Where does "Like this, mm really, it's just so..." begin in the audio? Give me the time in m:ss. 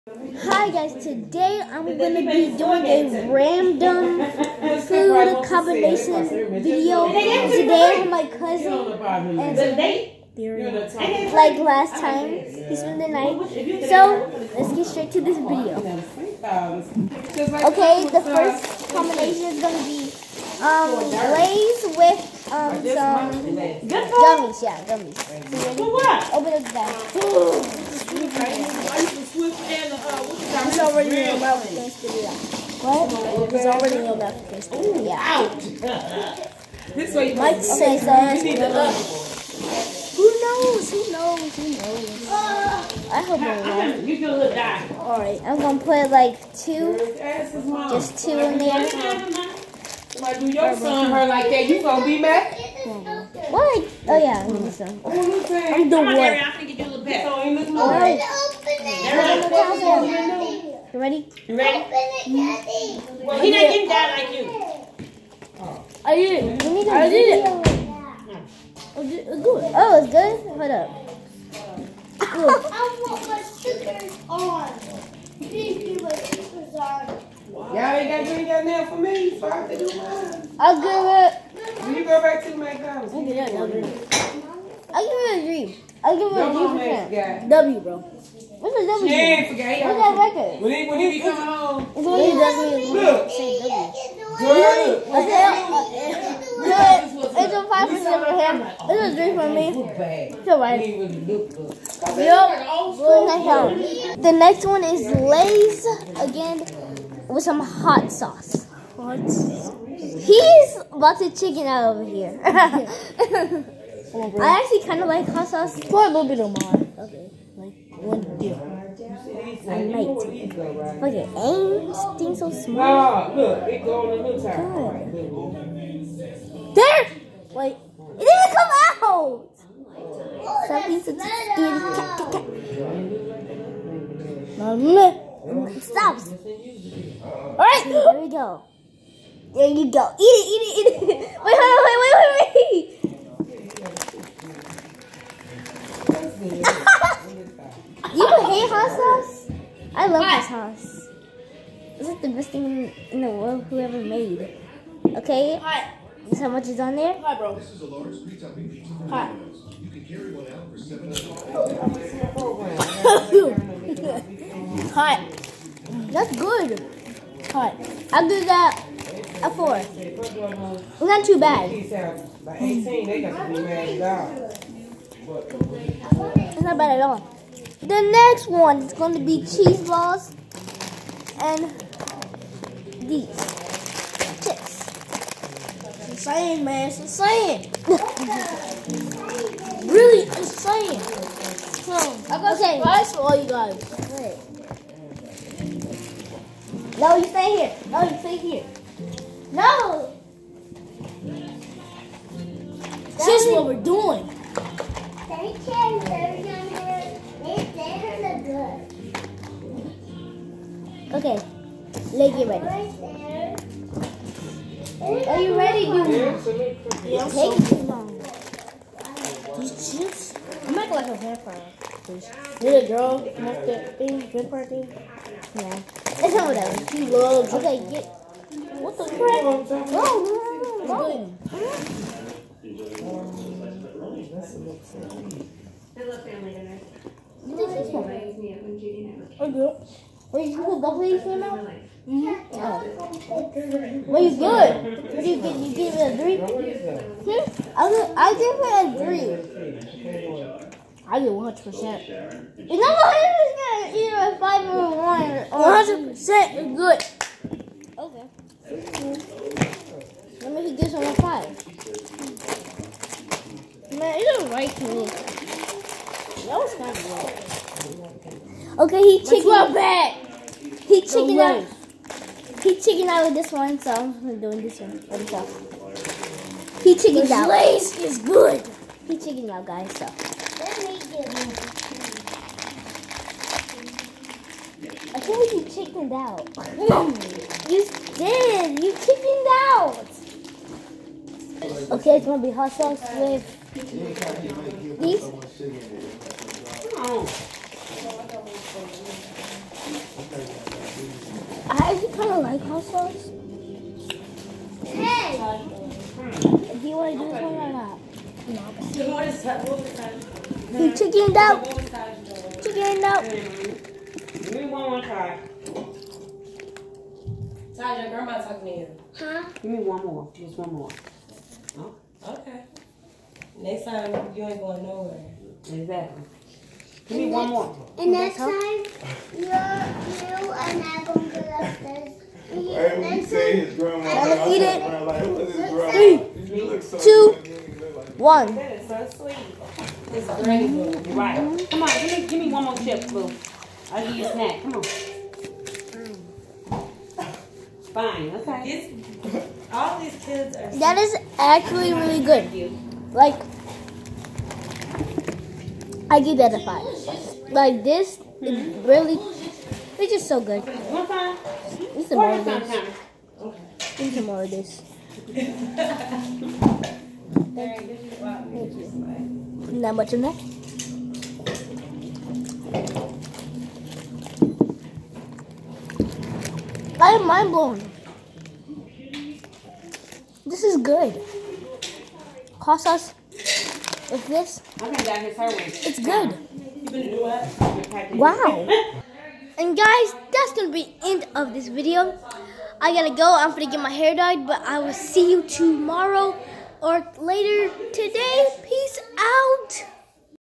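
5:57.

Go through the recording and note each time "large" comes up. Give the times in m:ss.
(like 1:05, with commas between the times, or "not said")
2:37.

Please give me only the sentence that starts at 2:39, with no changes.
You can carry one out for seven.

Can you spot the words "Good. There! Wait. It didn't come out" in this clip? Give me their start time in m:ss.
2:06.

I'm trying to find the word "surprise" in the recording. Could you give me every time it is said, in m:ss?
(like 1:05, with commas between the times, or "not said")
3:12.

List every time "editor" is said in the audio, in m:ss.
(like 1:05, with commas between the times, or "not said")
not said.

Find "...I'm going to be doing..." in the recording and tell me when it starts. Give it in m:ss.
0:01.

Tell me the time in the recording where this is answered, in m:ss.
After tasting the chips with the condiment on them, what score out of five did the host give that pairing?
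2:48.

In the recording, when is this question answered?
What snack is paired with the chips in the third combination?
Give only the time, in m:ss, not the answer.
2:59.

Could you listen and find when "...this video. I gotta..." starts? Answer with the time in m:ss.
6:31.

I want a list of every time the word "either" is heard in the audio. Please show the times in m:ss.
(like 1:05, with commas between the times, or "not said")
4:13.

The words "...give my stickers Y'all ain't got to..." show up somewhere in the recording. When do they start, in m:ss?
1:15.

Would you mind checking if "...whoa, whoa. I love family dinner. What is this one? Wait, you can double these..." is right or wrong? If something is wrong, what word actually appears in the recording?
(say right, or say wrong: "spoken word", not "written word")
right.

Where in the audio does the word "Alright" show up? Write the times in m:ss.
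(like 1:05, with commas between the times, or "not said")
0:44, 2:17.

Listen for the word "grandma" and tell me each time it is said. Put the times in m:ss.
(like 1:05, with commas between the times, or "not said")
5:18, 5:33.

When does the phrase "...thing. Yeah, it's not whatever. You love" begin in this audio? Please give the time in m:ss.
3:44.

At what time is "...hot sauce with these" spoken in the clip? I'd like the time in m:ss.
4:52.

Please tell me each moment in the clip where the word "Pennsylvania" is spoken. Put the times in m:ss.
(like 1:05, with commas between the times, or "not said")
not said.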